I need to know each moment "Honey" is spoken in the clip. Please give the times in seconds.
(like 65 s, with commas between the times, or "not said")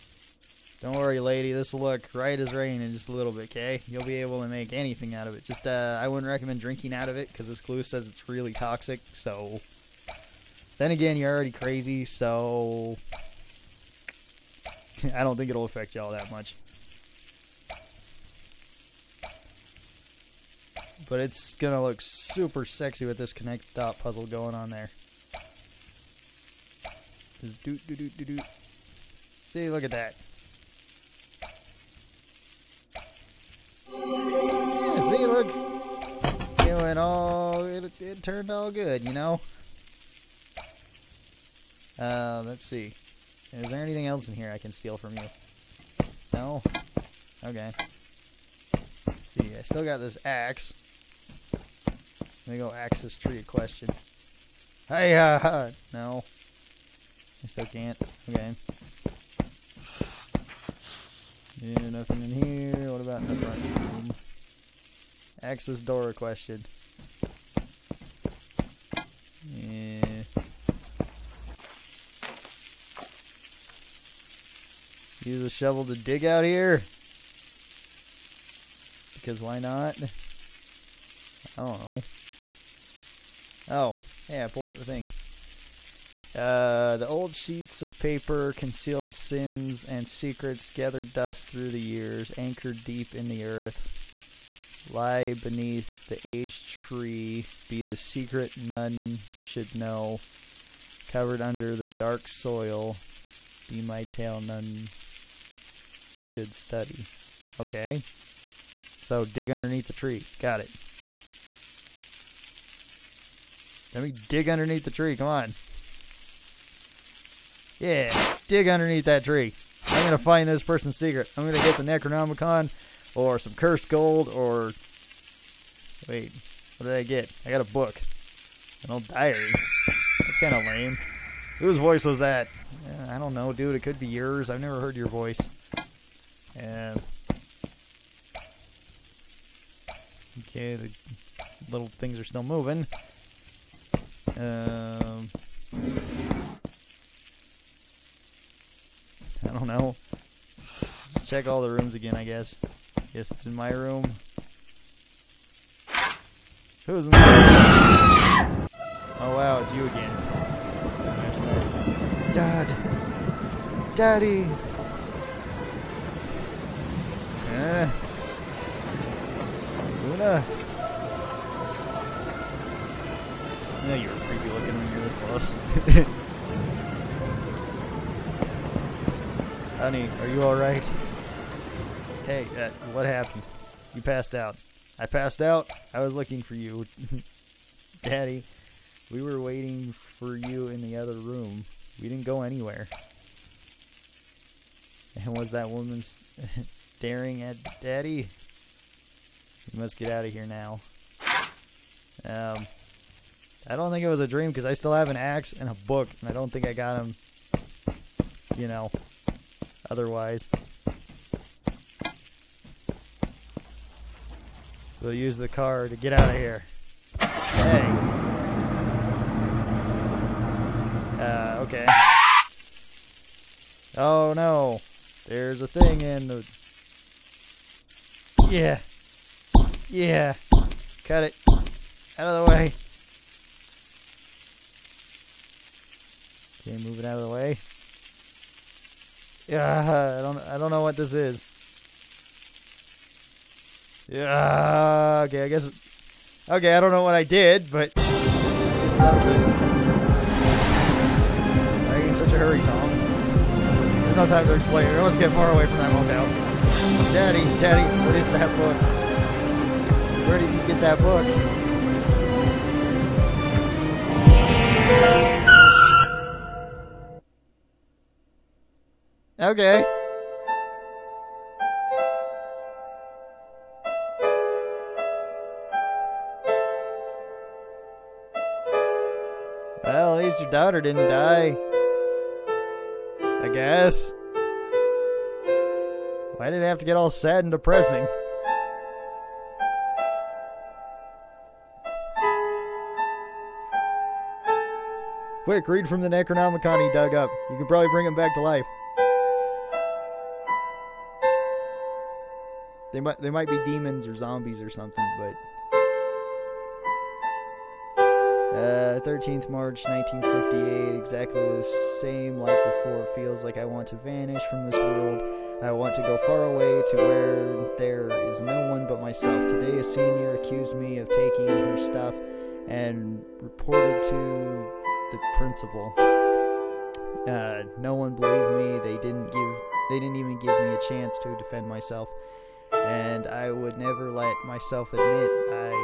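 179 s.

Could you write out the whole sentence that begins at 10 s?
Then again, you're already crazy, so...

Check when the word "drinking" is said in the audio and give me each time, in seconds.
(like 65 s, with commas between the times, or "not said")
6 s.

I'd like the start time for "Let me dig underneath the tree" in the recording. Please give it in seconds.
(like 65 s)
113 s.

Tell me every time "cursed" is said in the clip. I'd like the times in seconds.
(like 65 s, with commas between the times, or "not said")
123 s.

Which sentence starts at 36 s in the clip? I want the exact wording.
It went all, it, it turned all good, you know?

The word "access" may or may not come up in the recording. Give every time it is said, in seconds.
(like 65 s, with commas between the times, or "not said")
52 s, 65 s.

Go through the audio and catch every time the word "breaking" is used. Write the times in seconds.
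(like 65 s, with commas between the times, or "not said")
not said.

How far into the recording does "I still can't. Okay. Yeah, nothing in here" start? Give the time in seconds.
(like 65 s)
57 s.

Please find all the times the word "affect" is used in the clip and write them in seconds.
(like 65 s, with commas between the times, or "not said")
15 s.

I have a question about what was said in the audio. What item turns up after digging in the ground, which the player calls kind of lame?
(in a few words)
an old diary.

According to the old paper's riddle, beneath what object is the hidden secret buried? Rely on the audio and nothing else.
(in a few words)
the aged tree.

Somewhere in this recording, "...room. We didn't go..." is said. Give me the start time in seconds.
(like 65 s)
191 s.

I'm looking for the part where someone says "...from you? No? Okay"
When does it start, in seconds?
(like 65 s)
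44 s.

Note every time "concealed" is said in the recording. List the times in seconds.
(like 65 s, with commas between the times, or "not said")
88 s.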